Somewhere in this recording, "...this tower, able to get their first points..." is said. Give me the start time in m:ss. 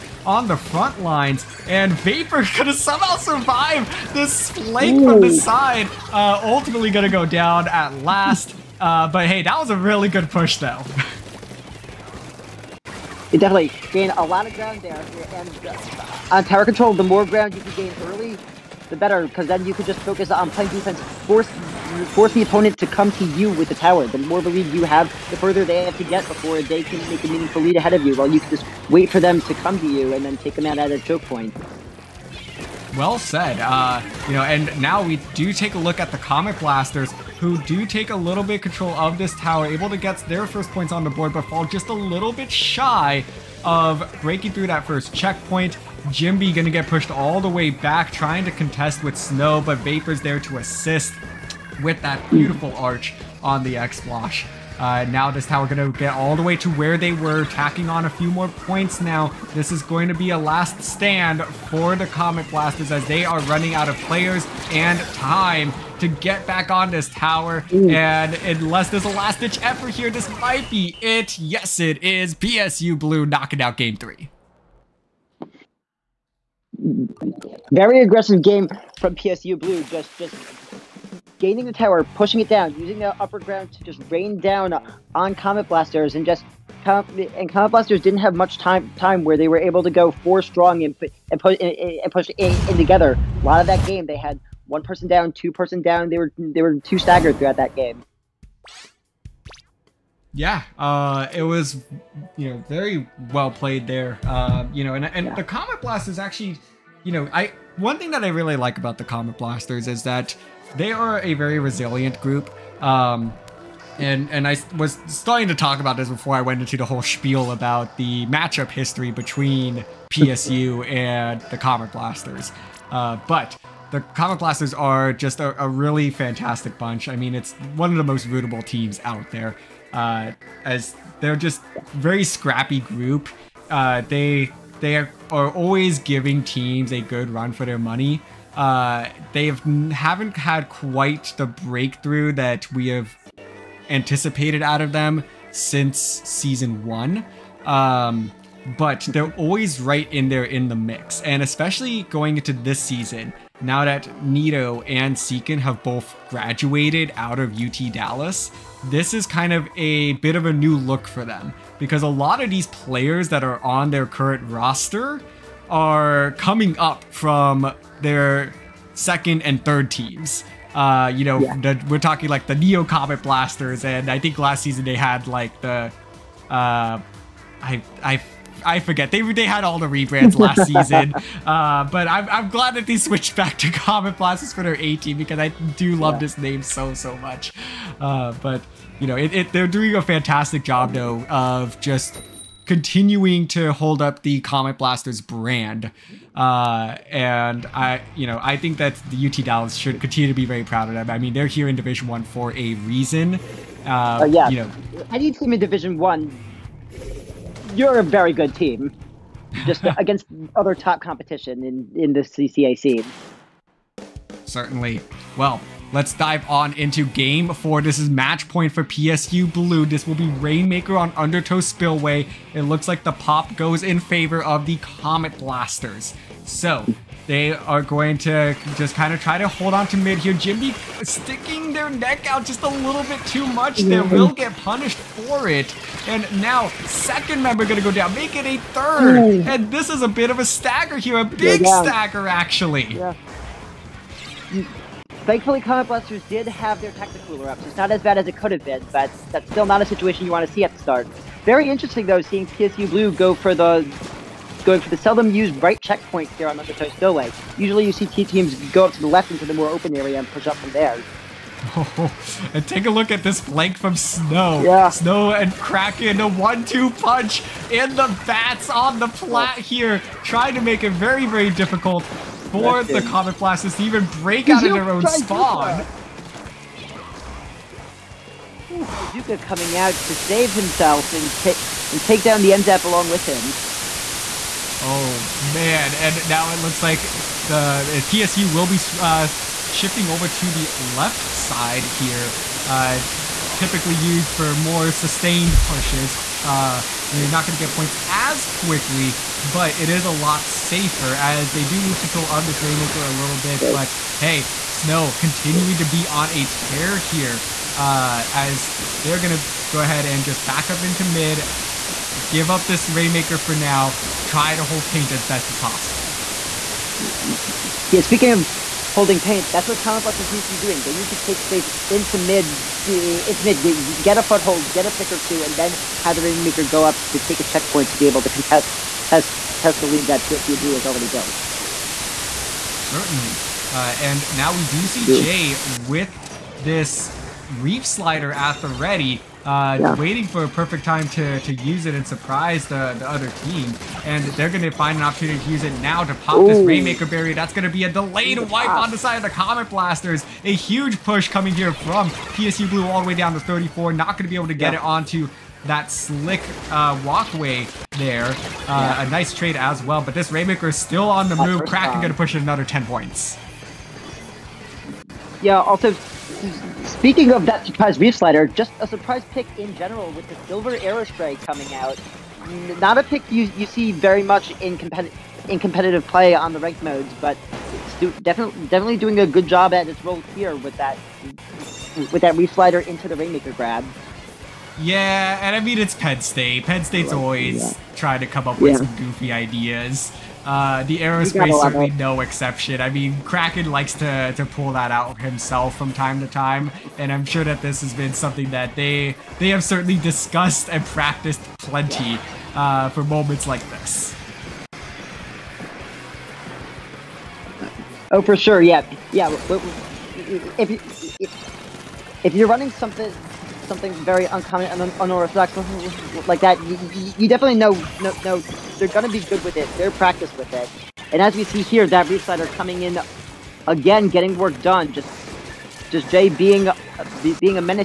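0:39.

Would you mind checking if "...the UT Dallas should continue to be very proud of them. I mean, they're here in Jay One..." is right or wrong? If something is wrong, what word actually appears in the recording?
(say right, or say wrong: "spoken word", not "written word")
wrong: "Division", not "Jay".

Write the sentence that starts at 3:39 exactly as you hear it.
This will be Rainmaker on Undertow Spillway.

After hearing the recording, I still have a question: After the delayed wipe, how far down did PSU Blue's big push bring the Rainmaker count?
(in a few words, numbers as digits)
34.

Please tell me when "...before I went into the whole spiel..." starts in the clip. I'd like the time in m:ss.
1:56.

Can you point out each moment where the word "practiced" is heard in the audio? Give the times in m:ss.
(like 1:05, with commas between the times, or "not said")
6:40, 6:59.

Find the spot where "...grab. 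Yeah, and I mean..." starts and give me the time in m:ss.
6:23.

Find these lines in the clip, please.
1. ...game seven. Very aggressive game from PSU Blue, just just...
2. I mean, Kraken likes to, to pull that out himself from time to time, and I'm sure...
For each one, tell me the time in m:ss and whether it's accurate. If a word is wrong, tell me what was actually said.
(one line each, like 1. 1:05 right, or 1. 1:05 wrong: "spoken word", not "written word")
1. 1:13 wrong: "three", not "seven"
2. 6:32 right.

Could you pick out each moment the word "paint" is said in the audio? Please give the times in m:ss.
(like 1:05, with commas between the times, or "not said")
5:14, 5:19.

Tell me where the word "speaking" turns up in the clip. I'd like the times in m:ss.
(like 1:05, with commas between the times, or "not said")
5:18, 6:06.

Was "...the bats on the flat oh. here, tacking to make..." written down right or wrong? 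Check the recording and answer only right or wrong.
wrong.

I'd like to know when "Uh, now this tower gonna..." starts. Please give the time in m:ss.
0:54.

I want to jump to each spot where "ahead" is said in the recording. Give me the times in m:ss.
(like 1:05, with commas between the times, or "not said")
0:27, 5:09.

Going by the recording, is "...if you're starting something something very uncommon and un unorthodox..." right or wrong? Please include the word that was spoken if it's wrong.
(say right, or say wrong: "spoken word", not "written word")
wrong: "running", not "starting".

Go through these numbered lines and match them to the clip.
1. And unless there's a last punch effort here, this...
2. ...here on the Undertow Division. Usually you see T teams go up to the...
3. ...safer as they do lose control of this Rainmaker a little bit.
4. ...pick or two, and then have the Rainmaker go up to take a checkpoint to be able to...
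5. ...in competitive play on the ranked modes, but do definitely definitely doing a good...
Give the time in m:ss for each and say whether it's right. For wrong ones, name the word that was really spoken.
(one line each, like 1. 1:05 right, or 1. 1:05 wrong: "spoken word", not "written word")
1. 1:07 wrong: "ditch", not "punch"
2. 4:16 wrong: "Stowaway", not "Division"
3. 5:00 right
4. 5:24 right
5. 6:15 right.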